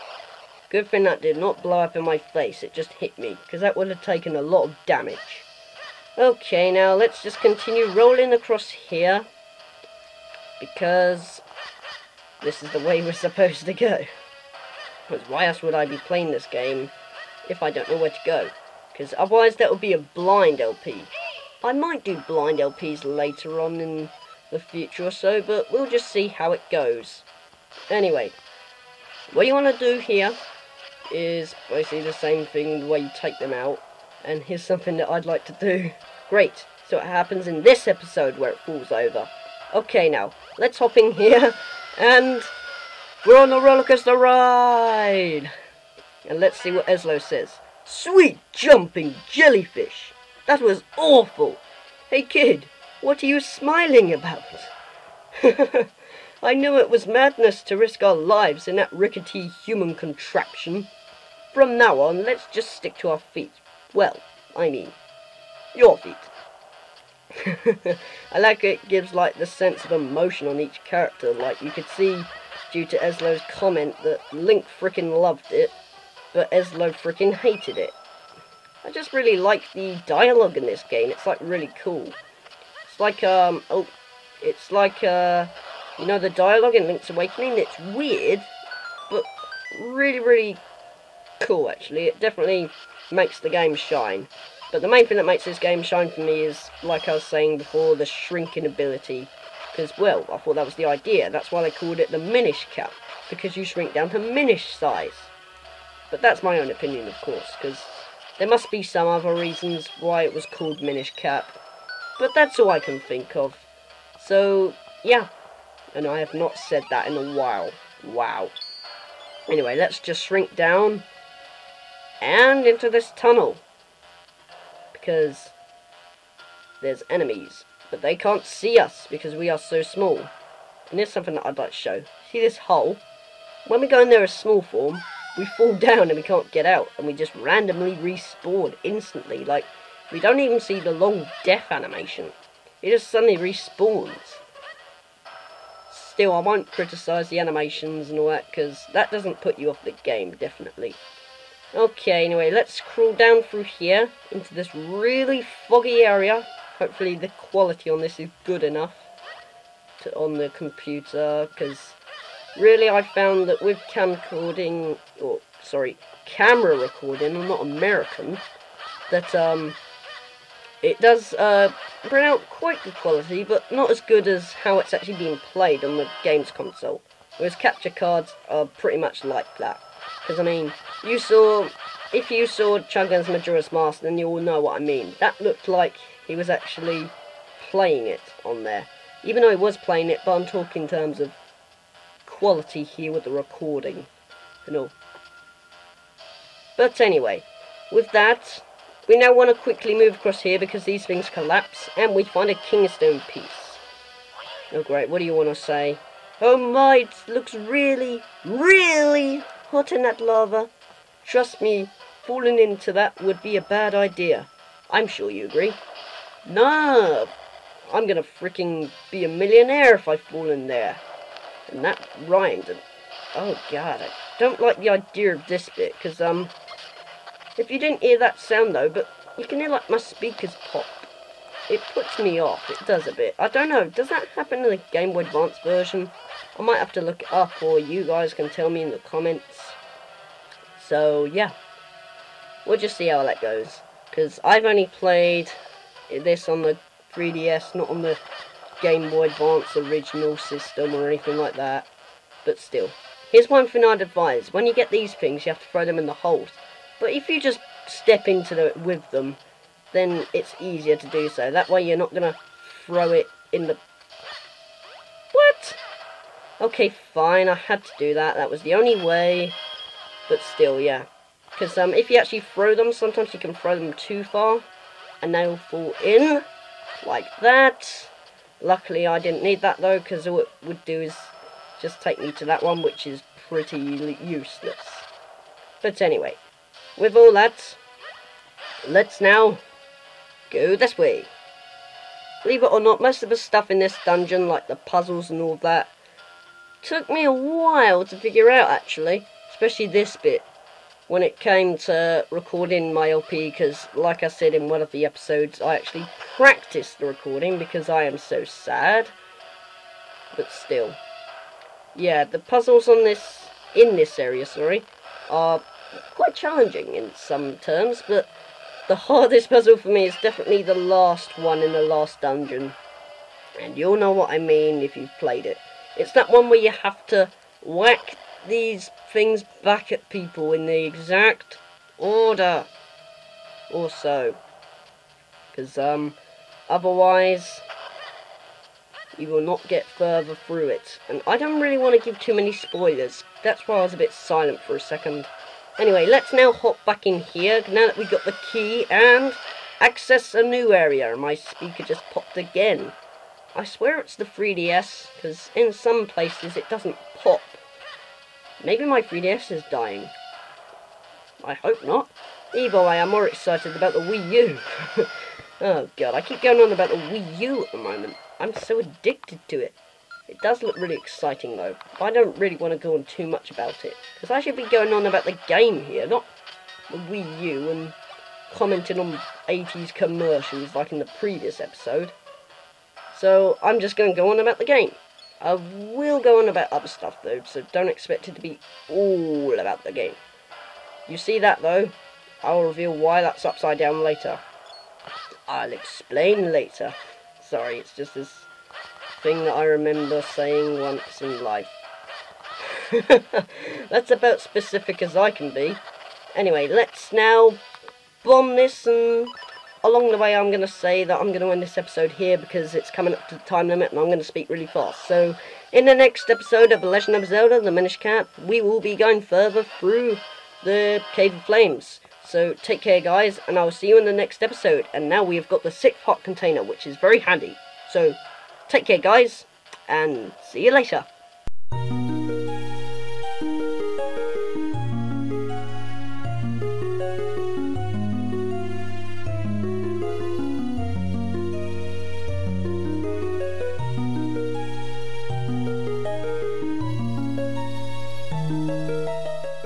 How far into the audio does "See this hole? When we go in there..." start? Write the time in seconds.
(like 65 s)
132 s.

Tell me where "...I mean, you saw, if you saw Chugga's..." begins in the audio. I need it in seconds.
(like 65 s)
180 s.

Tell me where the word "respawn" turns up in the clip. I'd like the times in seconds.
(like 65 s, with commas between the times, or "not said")
137 s, 143 s.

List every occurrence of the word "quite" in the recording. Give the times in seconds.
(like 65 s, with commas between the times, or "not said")
172 s, 316 s.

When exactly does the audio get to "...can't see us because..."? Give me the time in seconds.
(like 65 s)
128 s.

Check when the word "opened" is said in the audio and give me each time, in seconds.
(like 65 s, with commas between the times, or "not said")
not said.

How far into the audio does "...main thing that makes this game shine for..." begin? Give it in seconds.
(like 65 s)
94 s.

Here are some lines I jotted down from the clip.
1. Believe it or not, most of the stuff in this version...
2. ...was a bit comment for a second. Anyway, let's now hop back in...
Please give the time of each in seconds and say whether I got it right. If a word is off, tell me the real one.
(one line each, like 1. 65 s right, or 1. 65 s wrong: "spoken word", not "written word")
1. 292 s wrong: "dungeon", not "version"
2. 343 s wrong: "silent", not "comment".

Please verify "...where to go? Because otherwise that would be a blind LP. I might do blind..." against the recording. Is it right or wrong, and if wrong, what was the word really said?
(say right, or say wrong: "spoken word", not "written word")
right.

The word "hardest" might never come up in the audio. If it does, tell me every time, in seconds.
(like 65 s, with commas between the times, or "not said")
318 s.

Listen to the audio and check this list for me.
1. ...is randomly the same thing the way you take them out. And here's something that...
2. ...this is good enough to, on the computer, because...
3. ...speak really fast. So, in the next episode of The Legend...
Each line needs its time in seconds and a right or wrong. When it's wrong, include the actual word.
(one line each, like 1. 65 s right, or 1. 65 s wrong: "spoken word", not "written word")
1. 31 s wrong: "basically", not "randomly"
2. 157 s right
3. 414 s right.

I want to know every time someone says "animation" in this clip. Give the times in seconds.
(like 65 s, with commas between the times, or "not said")
141 s, 147 s.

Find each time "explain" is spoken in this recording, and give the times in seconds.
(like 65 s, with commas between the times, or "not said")
395 s.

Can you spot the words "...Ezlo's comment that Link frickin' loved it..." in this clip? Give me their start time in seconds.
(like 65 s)
72 s.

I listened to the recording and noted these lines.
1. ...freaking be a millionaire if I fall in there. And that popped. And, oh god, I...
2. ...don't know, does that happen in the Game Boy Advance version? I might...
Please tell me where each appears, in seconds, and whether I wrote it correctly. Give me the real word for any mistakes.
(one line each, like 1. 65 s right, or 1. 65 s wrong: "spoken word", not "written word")
1. 218 s wrong: "rhymed", not "popped"
2. 233 s right.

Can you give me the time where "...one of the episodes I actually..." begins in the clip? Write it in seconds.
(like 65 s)
304 s.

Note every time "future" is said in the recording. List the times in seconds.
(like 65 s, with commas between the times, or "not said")
24 s.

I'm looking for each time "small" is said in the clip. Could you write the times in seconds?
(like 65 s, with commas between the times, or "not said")
129 s, 134 s.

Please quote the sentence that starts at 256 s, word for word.
But if you just step into it the, with them, then it's easier to do so.